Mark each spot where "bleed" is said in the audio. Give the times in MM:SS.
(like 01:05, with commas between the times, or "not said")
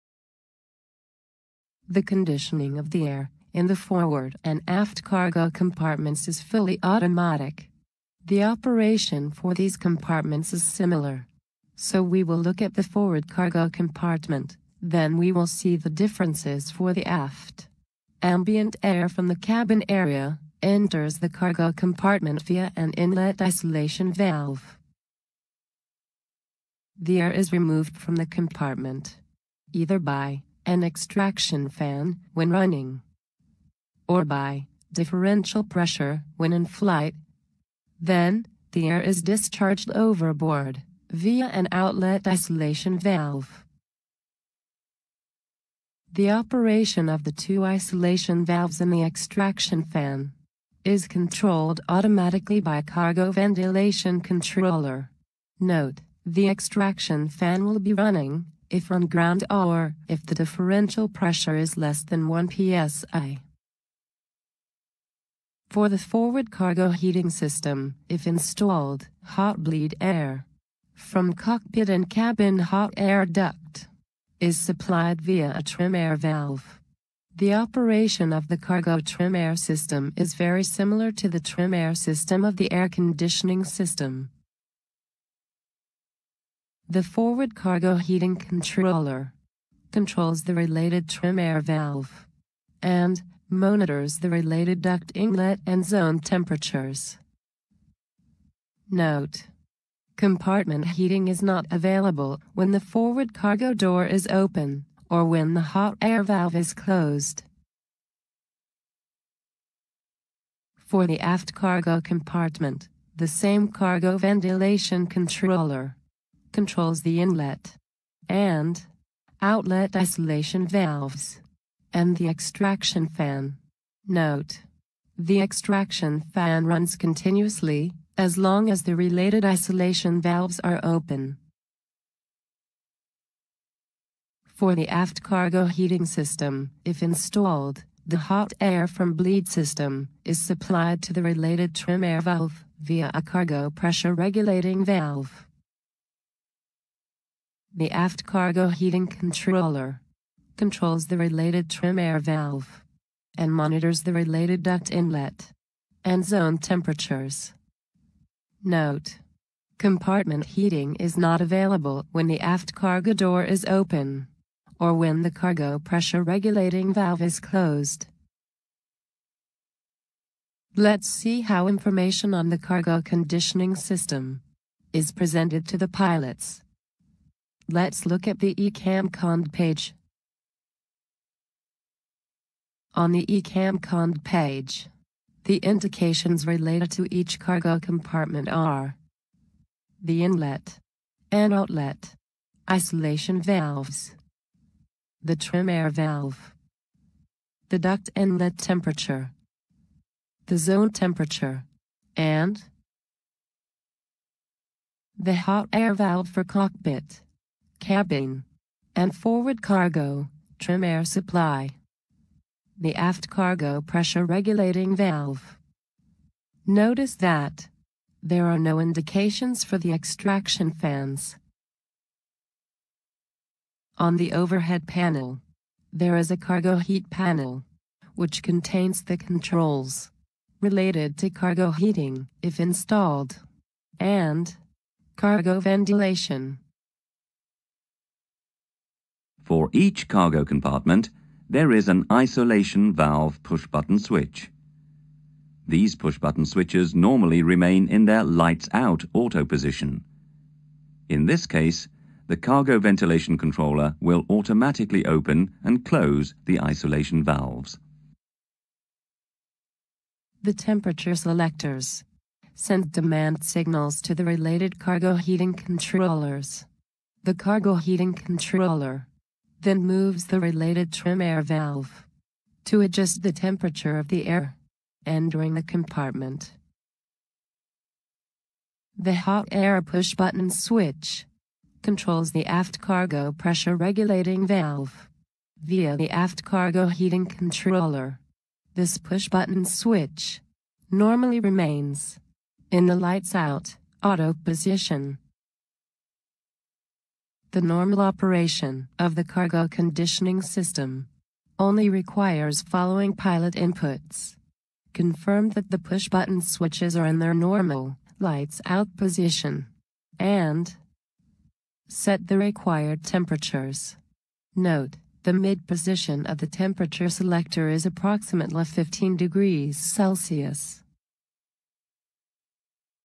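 01:09, 02:19.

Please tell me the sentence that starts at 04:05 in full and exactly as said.
These push-button switches normally remain in their lights-out auto position.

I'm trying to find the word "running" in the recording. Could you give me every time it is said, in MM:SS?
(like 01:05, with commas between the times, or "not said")
00:32, 00:57.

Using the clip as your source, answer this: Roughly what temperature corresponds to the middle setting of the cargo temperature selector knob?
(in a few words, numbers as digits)
15 degrees Celsius.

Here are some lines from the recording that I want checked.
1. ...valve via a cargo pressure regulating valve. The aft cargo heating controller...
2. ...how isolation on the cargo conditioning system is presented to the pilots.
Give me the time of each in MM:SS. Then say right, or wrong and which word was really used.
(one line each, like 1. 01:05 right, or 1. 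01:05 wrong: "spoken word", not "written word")
1. 02:22 right
2. 02:51 wrong: "information", not "isolation".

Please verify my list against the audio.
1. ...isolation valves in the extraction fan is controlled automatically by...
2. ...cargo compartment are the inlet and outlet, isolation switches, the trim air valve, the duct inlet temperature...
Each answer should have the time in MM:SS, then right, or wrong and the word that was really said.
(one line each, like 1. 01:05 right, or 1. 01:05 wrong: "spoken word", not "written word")
1. 00:47 right
2. 03:07 wrong: "valves", not "switches".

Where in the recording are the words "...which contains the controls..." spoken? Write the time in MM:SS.
03:48.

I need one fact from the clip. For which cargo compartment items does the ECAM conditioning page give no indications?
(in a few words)
extraction fans.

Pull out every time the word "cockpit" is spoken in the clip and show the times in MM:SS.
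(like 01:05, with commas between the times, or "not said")
01:11, 03:26.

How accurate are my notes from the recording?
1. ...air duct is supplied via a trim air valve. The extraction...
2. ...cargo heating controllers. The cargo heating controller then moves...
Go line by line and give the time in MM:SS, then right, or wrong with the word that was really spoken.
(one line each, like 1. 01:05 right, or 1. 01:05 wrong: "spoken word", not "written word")
1. 01:12 wrong: "operation", not "extraction"
2. 04:24 right.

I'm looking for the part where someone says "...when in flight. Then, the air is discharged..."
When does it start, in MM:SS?
00:36.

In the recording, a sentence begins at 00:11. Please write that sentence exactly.
So we will look at the forward cargo compartment, then we will see the differences for the aft.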